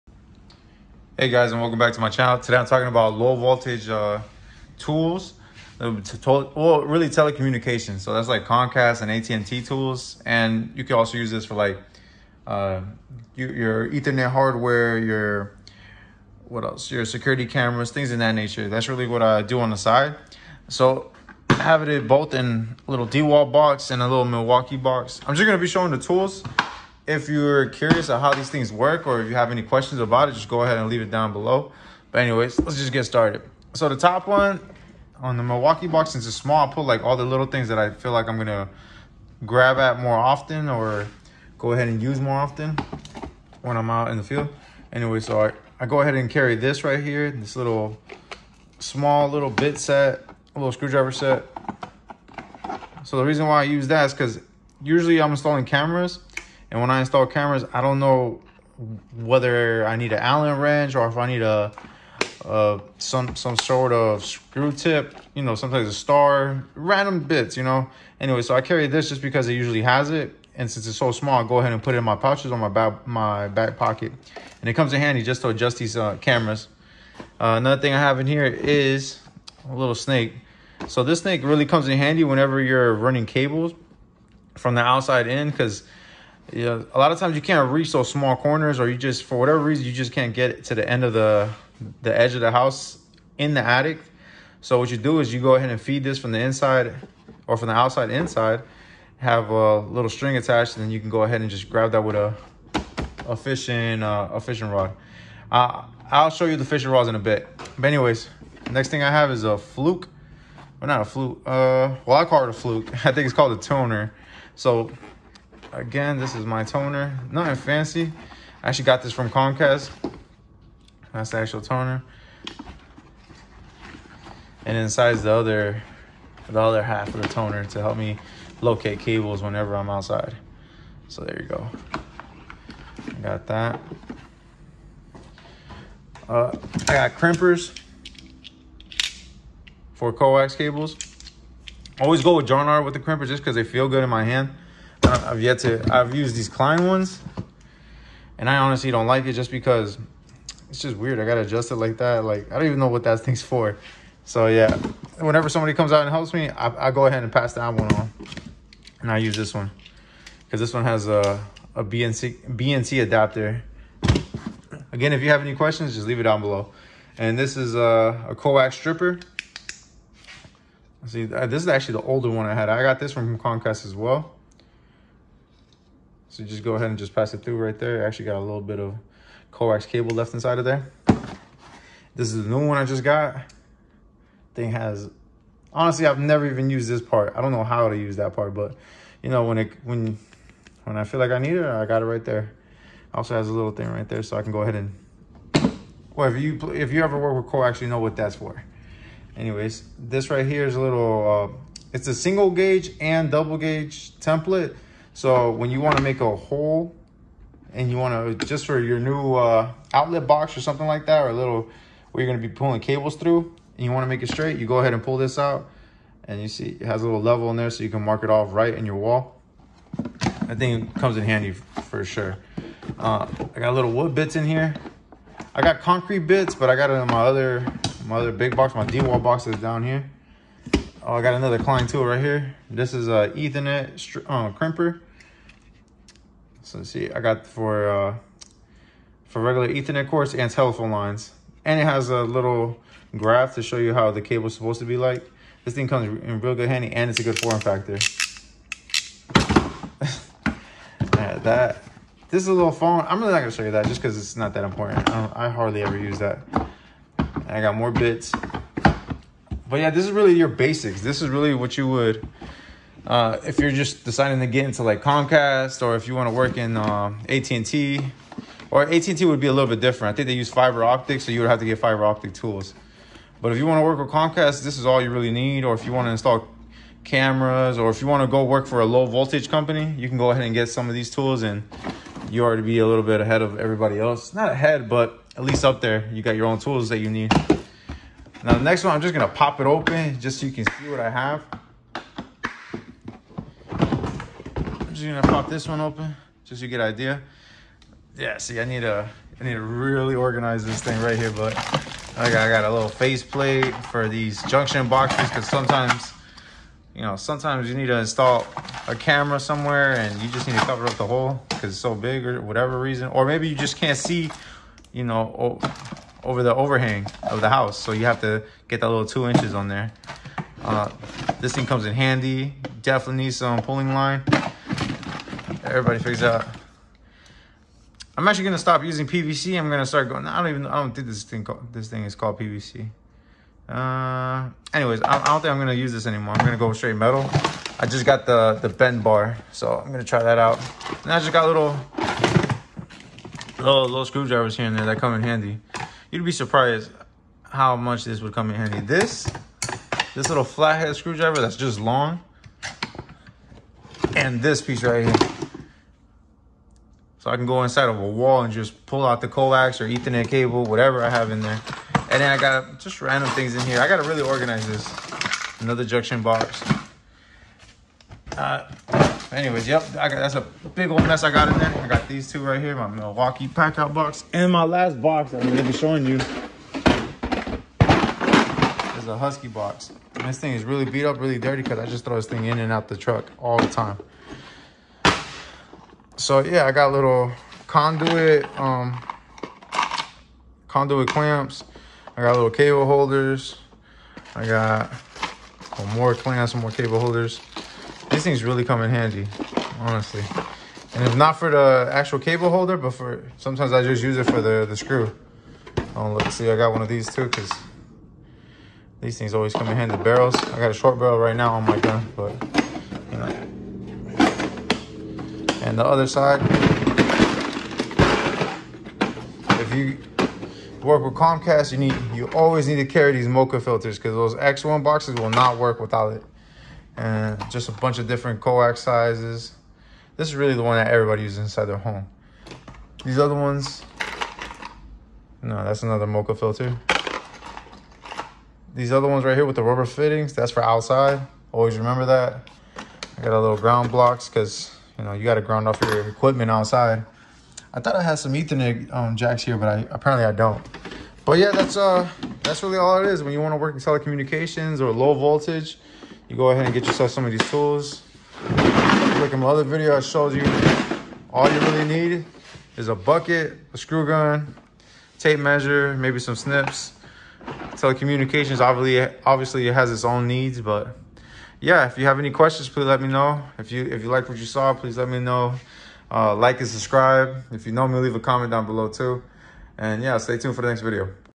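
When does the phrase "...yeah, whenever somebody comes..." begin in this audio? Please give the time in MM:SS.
02:34.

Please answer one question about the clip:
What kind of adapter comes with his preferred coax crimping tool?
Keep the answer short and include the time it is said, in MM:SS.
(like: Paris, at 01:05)
BNC adapter, at 02:42.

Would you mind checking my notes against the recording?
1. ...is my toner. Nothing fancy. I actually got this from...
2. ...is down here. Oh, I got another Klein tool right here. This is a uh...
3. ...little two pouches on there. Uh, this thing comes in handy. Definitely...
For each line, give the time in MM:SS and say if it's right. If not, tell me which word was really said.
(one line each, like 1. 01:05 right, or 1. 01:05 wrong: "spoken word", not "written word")
1. 01:56 right
2. 03:49 right
3. 05:18 wrong: "inches", not "pouches".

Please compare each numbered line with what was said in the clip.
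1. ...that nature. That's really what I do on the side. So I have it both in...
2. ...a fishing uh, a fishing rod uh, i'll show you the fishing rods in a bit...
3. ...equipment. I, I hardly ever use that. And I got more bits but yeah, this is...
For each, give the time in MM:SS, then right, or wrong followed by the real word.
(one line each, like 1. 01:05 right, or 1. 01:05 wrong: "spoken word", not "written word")
1. 00:18 right
2. 01:43 right
3. 04:14 wrong: "important", not "equipment".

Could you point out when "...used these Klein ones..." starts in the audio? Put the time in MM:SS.
02:26.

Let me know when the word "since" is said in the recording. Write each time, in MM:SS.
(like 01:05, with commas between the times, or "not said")
00:36, 01:10.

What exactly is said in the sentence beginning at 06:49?
Barrels, I got a short barrel right now on my gun, but, you know.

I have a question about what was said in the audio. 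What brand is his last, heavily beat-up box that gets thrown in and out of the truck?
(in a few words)
Husky.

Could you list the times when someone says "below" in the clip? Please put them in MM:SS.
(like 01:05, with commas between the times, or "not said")
00:31, 02:46, 07:58.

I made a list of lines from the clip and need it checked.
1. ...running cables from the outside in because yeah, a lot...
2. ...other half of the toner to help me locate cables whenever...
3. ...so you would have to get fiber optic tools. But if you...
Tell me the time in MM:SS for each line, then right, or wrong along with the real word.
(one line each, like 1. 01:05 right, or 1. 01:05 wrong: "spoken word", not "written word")
1. 01:22 right
2. 02:06 right
3. 04:31 right.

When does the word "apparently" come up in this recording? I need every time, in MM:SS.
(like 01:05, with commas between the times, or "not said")
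07:29.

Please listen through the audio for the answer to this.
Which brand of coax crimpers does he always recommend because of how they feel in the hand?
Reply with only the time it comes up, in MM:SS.
02:22.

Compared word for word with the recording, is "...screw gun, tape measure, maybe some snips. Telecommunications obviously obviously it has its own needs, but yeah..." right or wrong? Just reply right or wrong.
right.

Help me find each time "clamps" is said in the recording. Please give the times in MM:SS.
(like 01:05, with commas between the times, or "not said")
06:31, 06:36.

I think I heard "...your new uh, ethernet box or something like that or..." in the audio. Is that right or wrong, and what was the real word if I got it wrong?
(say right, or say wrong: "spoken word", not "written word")
wrong: "outlet", not "ethernet".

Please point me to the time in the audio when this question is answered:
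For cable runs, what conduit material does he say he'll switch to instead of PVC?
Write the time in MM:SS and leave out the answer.
05:36.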